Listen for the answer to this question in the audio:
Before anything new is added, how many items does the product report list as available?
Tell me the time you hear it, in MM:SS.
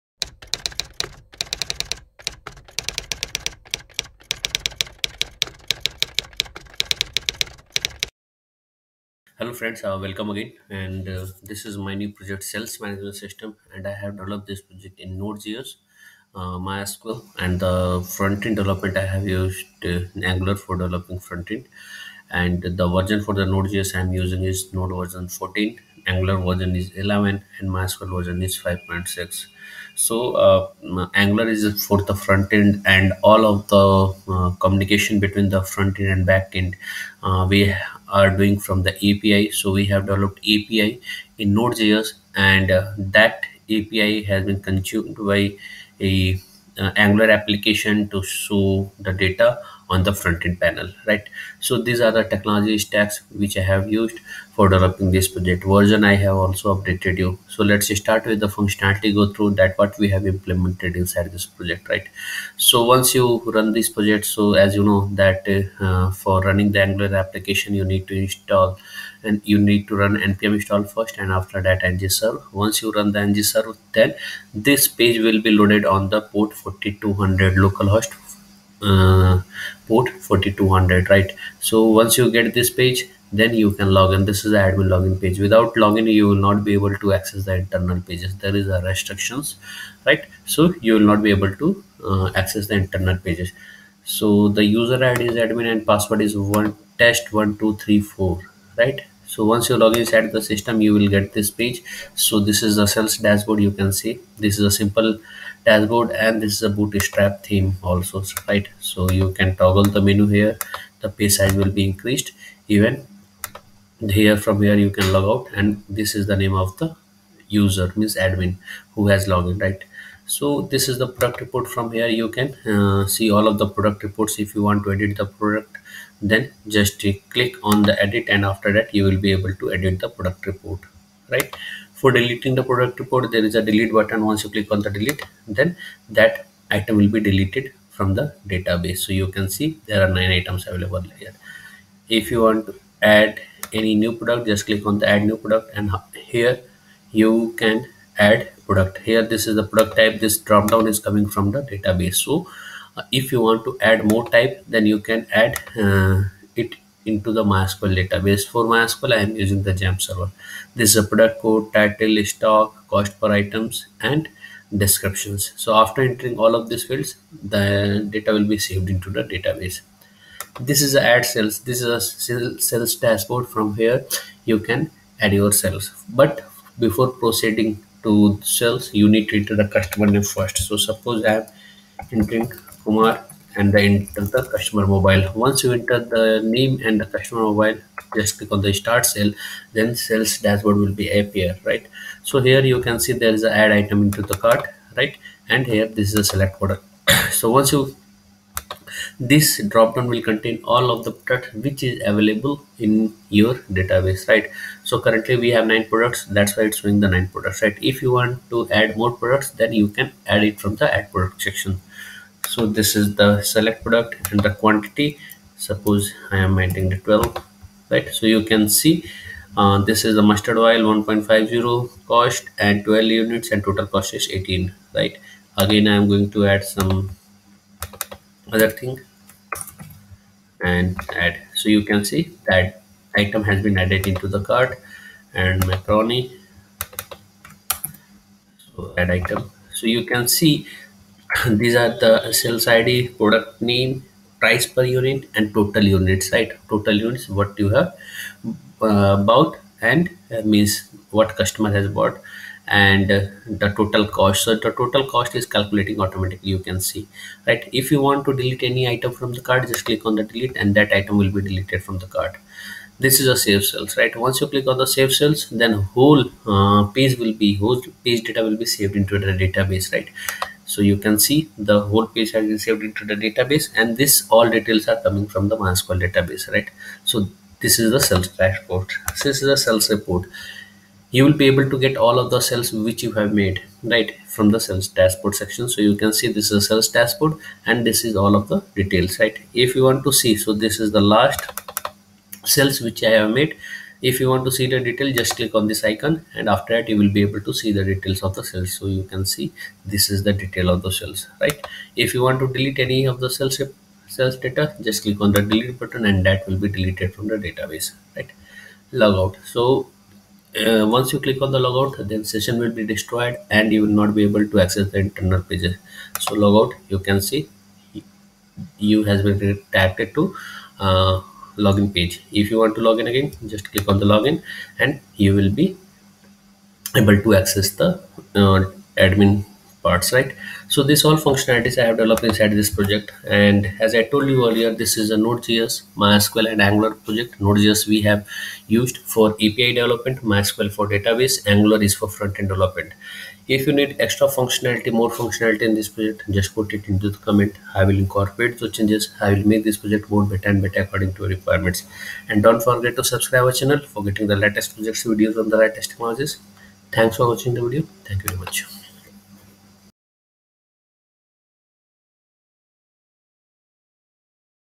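02:20.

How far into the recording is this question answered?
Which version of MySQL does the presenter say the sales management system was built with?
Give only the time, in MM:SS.
00:28.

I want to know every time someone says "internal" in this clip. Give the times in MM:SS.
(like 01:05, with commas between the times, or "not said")
01:27, 01:32, 05:14.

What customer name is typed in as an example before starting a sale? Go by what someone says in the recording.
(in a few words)
Kumar.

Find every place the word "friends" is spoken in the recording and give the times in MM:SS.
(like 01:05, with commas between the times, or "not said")
00:09.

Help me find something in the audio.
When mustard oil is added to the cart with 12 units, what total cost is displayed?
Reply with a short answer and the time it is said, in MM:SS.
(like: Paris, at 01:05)
18, at 03:44.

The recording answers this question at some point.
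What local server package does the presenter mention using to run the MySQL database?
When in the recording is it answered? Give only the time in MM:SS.
02:39.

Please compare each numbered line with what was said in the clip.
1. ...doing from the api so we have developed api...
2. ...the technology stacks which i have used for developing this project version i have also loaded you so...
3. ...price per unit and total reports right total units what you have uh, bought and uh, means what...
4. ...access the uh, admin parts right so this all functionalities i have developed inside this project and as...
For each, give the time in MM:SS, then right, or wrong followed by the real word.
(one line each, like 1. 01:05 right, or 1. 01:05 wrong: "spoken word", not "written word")
1. 00:38 right
2. 00:52 wrong: "updated", not "loaded"
3. 04:04 wrong: "units", not "reports"
4. 05:27 right.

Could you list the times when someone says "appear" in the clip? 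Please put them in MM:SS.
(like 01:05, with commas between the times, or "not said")
03:11.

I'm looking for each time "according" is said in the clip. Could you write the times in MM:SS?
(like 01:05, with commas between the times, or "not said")
05:50.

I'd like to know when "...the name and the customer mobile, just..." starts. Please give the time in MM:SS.
03:05.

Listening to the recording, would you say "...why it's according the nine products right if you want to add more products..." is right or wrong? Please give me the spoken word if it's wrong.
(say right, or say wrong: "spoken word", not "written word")
wrong: "showing", not "according".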